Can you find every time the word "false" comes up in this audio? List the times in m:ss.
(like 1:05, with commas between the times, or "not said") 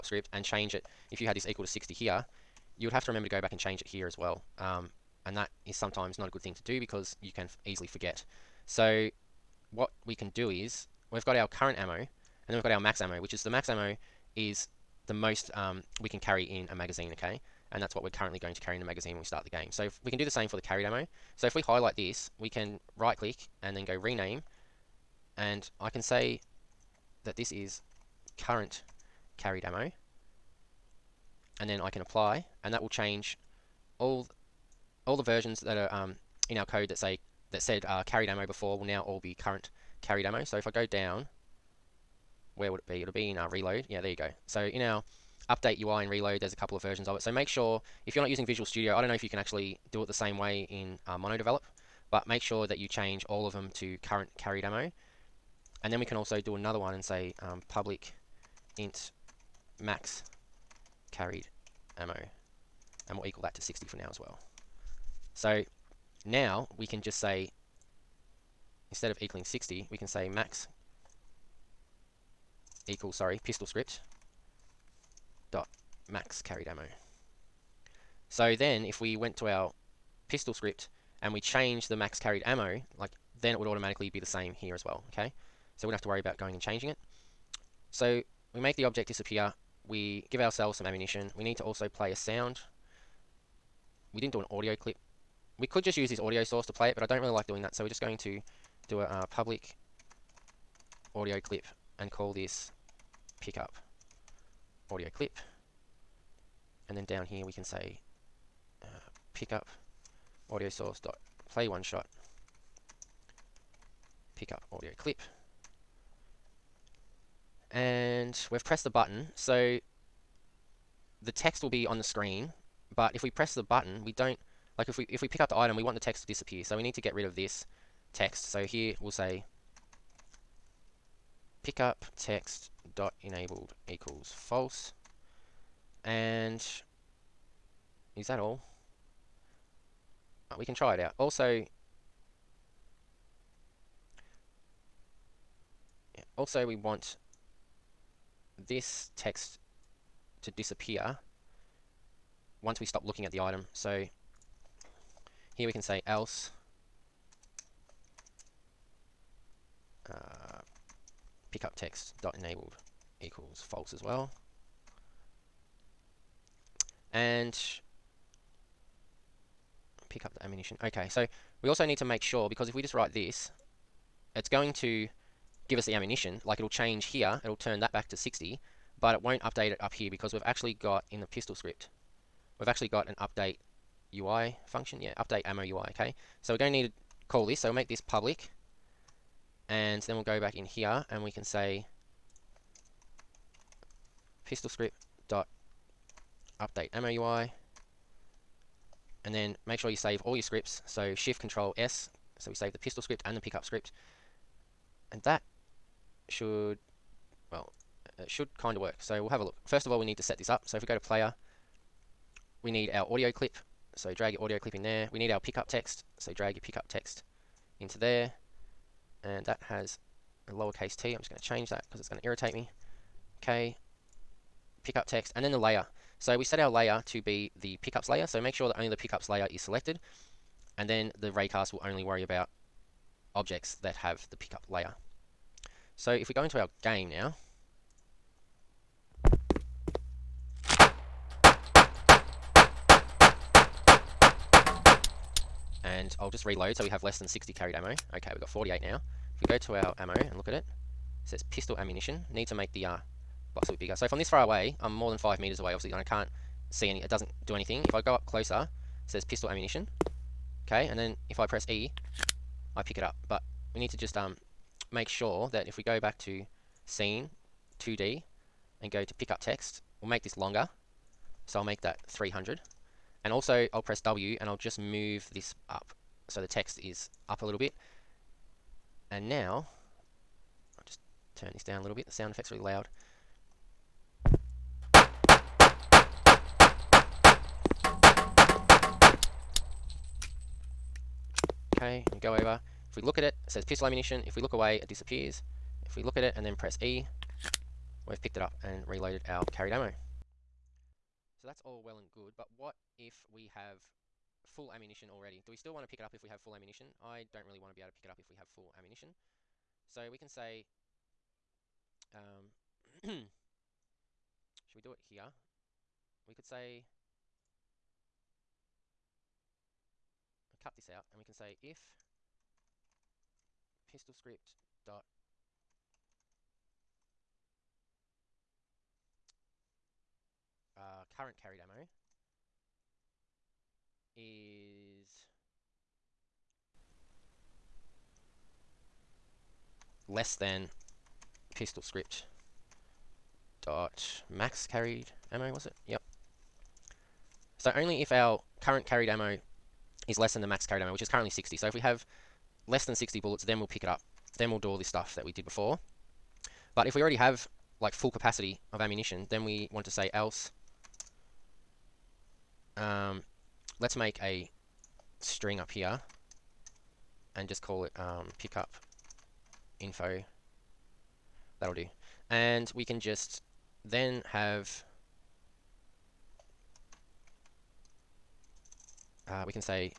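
2:14, 2:43.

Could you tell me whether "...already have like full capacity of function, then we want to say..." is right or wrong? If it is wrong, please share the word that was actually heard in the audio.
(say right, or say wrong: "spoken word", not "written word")
wrong: "ammunition", not "function".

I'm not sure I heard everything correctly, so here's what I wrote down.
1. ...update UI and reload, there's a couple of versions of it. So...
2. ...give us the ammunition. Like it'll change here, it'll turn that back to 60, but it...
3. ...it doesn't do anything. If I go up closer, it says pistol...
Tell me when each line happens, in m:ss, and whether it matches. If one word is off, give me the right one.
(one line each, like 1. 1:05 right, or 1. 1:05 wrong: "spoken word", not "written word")
1. 0:45 right
2. 2:55 right
3. 4:17 right.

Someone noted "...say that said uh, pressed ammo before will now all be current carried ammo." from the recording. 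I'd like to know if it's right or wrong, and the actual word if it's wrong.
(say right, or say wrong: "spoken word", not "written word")
wrong: "carried", not "pressed".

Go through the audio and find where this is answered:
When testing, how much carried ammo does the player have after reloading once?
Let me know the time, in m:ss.
4:08.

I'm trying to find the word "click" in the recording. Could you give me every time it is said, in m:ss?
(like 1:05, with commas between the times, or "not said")
0:23.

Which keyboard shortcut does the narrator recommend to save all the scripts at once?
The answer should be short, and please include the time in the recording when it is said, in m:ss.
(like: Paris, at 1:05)
shift control S, at 3:21.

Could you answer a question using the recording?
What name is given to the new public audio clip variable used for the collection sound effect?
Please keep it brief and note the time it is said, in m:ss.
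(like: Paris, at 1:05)
pickup audio clip, at 1:43.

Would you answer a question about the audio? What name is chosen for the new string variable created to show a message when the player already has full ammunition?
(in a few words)
pick up info.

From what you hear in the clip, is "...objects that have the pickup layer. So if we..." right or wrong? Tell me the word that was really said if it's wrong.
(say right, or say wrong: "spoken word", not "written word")
right.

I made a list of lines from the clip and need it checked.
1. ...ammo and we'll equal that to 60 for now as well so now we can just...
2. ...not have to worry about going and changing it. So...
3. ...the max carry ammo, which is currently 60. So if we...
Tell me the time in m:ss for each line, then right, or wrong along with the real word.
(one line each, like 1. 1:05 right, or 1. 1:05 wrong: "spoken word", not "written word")
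1. 1:01 right
2. 1:25 right
3. 5:50 right.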